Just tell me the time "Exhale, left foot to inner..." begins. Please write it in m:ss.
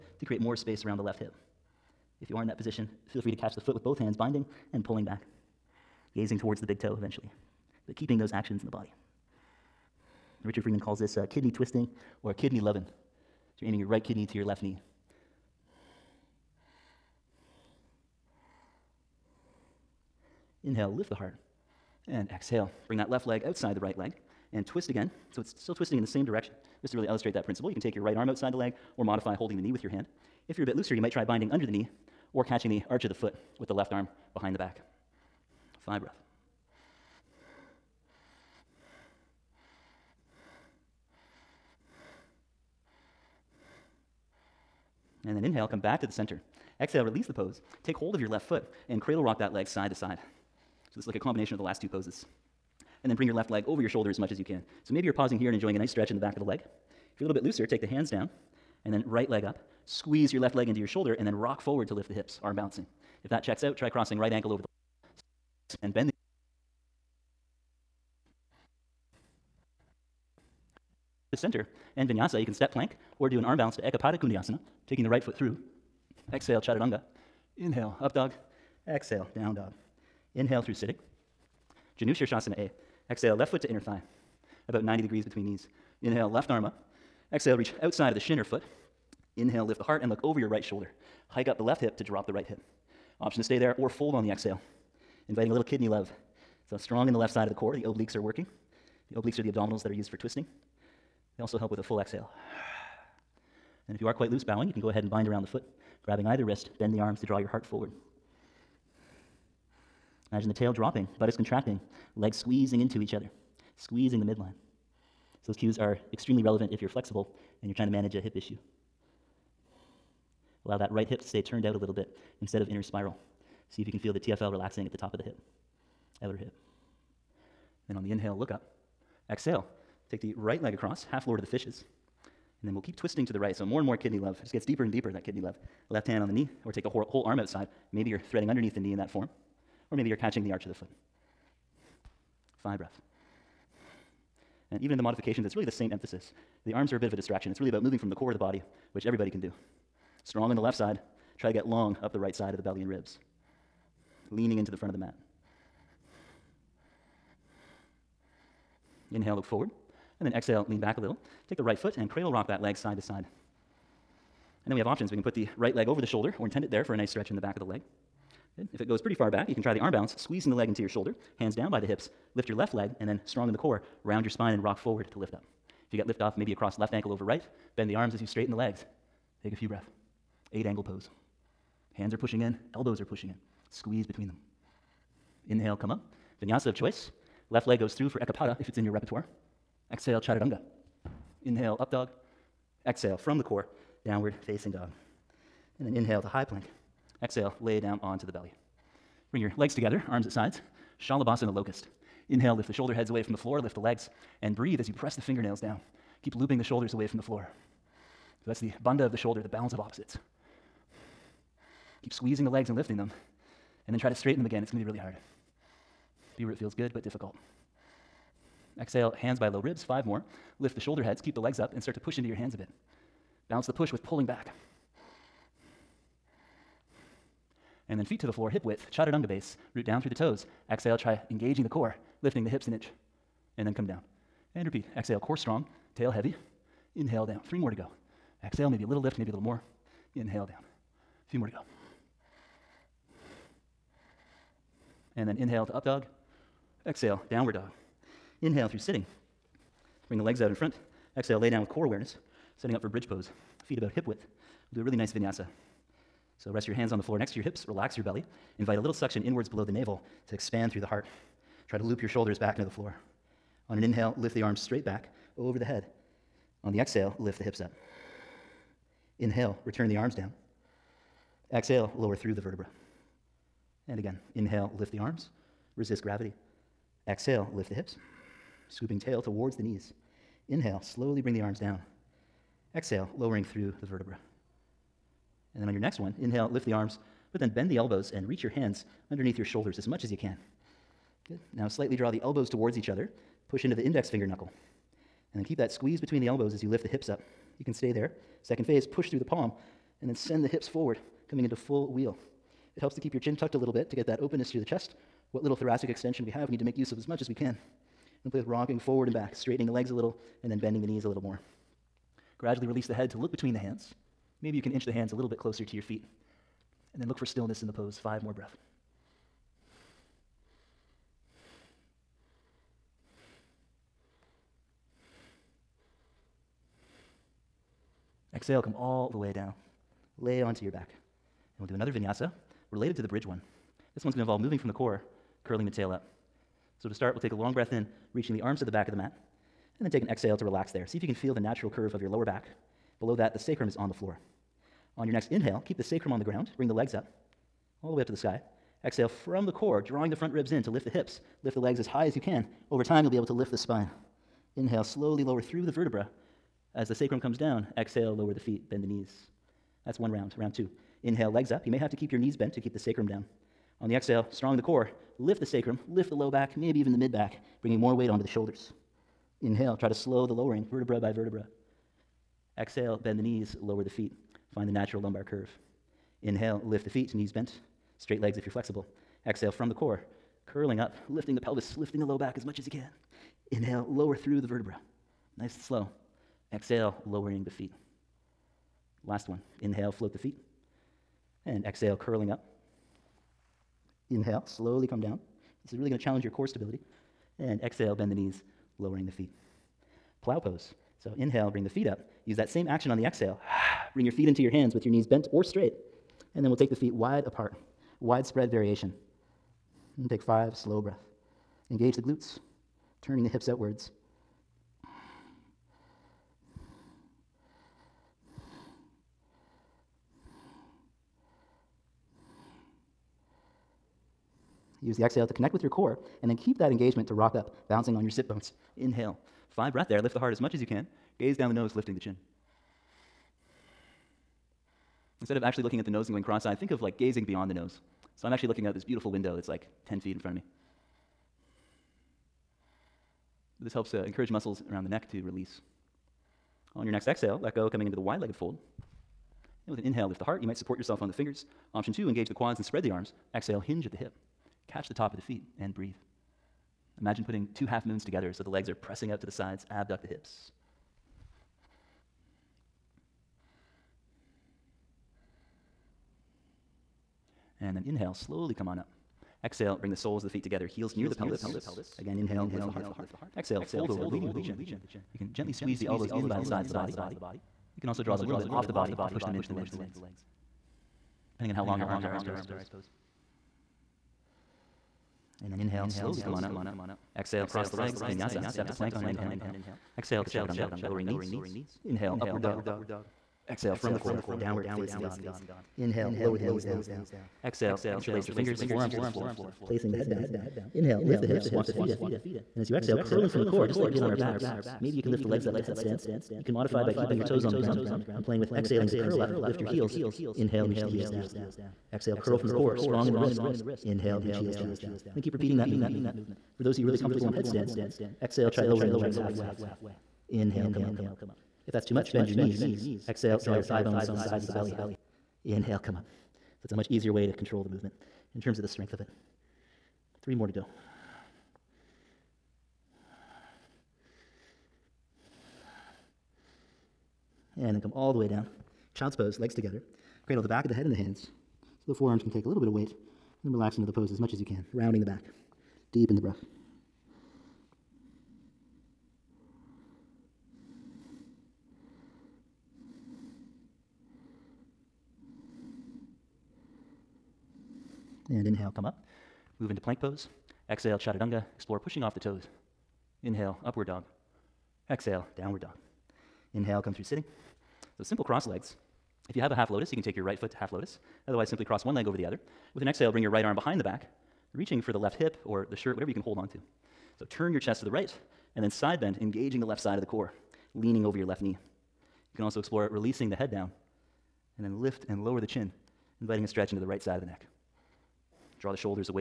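1:23.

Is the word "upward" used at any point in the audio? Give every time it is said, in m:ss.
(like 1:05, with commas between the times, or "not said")
8:12, 9:23.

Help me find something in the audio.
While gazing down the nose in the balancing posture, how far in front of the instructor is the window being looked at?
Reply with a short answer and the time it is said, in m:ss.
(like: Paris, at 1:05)
10 feet, at 7:19.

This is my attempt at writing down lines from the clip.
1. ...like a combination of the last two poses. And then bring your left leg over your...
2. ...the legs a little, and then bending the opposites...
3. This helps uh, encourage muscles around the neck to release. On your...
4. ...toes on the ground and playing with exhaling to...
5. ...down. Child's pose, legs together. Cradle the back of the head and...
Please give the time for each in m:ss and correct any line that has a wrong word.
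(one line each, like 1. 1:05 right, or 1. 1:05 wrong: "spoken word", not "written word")
1. 0:51 right
2. 5:09 wrong: "knees", not "opposites"
3. 7:23 right
4. 8:27 right
5. 8:58 right.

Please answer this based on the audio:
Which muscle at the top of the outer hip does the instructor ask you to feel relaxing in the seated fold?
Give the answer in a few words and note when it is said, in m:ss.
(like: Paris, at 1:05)
TFL, at 2:04.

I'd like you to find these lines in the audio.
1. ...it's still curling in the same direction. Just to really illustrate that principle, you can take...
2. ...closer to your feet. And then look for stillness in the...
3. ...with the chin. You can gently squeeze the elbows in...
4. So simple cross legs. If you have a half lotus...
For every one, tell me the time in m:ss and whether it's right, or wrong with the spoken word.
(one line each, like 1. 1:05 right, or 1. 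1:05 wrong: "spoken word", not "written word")
1. 0:25 wrong: "twisting", not "curling"
2. 5:15 right
3. 7:54 right
4. 9:27 right.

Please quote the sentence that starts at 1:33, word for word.
Option to stay there or fold on the exhale, inviting a little kidney love.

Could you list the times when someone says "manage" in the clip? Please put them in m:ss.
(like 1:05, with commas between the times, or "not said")
1:57.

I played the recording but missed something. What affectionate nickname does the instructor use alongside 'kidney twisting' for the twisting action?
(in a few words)
kidney loving.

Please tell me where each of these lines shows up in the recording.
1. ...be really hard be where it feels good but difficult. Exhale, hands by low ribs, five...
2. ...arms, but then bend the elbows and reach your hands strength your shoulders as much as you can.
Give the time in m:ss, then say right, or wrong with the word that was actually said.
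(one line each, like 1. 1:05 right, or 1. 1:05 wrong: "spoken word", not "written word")
1. 3:34 right
2. 4:46 wrong: "underneath", not "strength".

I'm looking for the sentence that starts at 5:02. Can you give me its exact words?
It helps to keep your chin tucked a little bit to get that openness through the chest.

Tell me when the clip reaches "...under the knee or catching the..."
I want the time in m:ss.
0:31.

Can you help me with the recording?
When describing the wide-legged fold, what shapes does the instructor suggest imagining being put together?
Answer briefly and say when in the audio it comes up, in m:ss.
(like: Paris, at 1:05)
two half moons, at 7:37.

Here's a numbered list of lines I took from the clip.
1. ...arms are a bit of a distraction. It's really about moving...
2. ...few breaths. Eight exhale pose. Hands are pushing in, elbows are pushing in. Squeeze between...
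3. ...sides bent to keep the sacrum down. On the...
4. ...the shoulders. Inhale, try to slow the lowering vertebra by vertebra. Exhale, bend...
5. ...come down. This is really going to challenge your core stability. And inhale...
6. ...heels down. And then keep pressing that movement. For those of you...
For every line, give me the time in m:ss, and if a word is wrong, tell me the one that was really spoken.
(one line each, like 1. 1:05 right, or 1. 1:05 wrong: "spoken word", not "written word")
1. 2:26 right
2. 2:59 wrong: "angle", not "exhale"
3. 6:02 wrong: "knees", not "sides"
4. 6:08 right
5. 6:34 wrong: "exhale", not "inhale"
6. 8:34 wrong: "repeating", not "pressing".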